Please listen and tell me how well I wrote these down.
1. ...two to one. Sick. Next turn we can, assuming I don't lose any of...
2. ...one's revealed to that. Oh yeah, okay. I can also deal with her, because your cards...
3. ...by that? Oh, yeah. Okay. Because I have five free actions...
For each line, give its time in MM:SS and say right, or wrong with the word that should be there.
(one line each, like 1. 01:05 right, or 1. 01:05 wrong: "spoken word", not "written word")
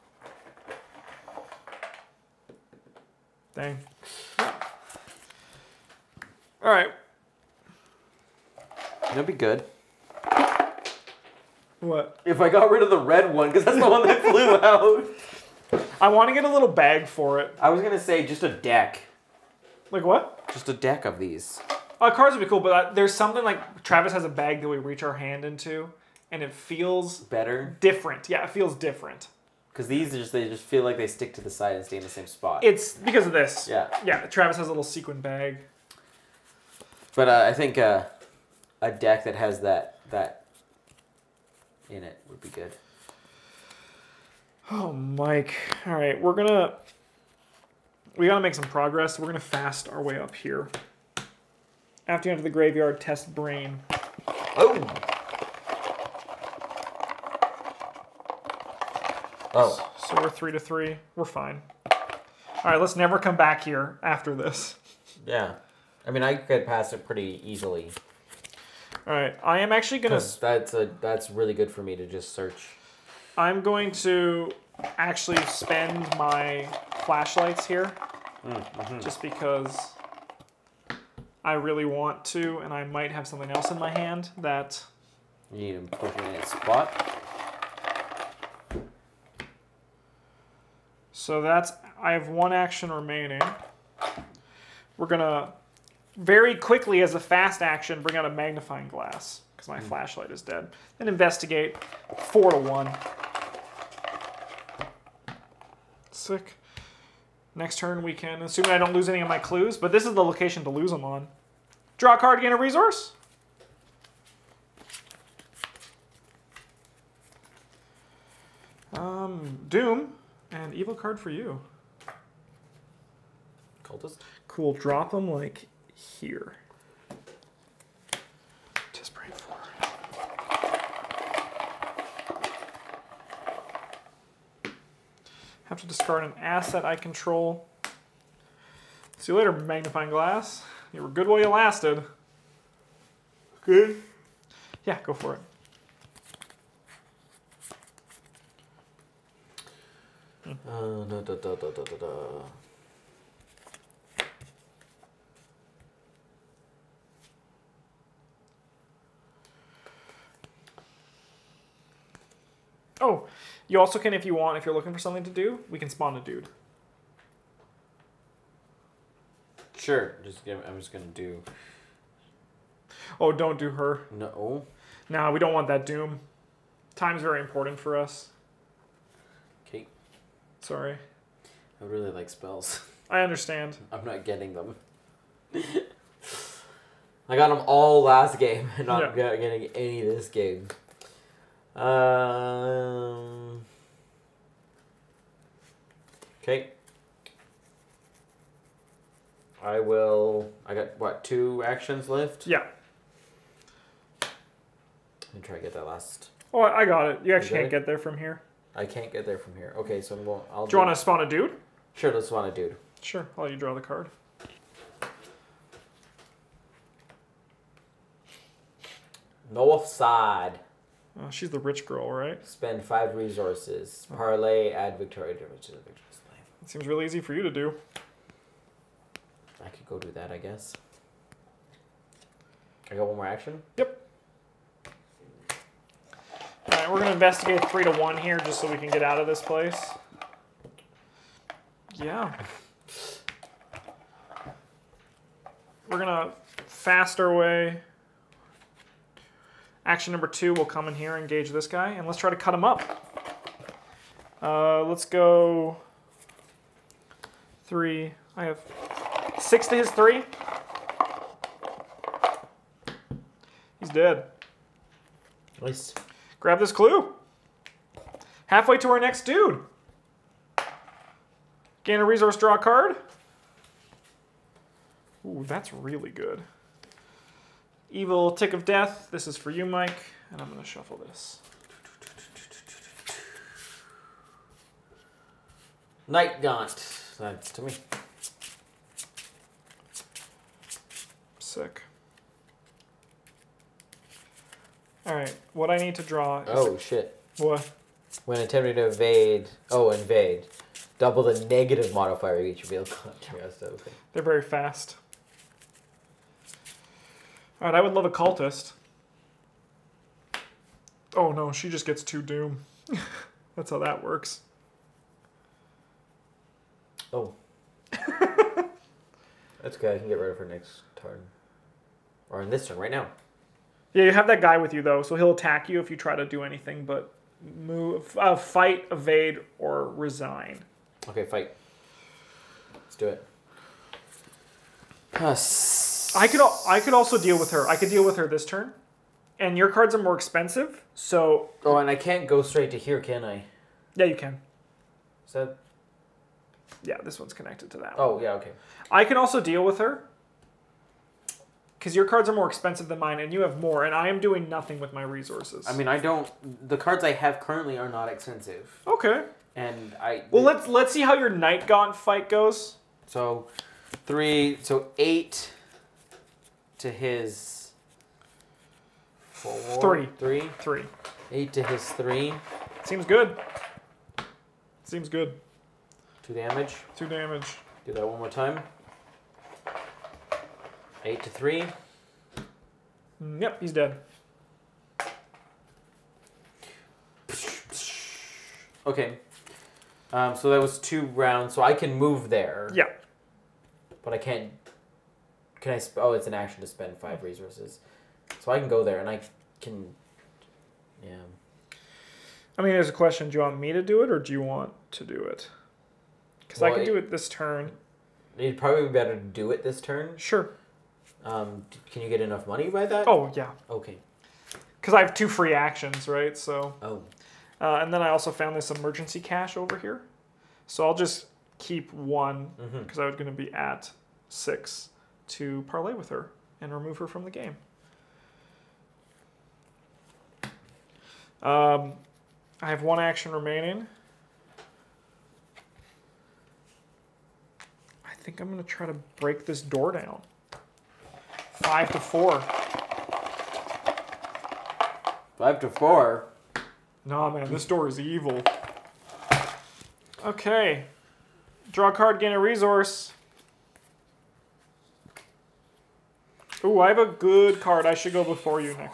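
1. 01:42 wrong: "four", not "two"
2. 05:47 wrong: "connected", not "revealed"
3. 06:52 wrong: "two", not "five".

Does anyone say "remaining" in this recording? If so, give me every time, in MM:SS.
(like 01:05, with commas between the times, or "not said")
01:32, 07:13.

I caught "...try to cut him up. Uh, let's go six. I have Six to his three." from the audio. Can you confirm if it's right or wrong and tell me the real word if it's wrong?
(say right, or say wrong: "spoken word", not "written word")
wrong: "three", not "six".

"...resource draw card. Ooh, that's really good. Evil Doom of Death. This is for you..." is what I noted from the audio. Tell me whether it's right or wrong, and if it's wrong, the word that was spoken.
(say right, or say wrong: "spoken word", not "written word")
wrong: "Tick", not "Doom".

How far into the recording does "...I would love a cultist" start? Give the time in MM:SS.
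05:07.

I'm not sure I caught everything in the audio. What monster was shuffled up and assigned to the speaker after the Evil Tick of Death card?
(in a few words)
Nightgaunt.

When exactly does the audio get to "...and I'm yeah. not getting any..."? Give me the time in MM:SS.
03:08.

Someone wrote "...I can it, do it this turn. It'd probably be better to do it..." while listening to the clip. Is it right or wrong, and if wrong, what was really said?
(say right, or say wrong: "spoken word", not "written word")
right.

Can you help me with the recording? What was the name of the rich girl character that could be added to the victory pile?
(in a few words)
Victoria.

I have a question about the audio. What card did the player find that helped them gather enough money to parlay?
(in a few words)
Emergency cash.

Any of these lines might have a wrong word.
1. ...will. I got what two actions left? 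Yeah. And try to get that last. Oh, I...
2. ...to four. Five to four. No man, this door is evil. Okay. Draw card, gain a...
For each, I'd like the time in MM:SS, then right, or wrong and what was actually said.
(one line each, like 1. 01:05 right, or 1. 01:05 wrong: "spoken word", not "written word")
1. 03:19 right
2. 07:21 right.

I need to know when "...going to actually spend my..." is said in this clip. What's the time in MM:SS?
01:13.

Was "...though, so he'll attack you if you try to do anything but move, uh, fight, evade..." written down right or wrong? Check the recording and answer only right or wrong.
right.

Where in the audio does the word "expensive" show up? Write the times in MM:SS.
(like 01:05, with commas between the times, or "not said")
05:40, 05:52, 05:58.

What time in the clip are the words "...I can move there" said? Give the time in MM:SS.
06:31.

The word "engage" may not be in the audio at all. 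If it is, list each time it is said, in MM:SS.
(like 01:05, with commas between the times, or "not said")
04:11.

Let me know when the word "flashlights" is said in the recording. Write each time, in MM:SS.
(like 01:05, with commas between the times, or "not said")
01:17, 01:39.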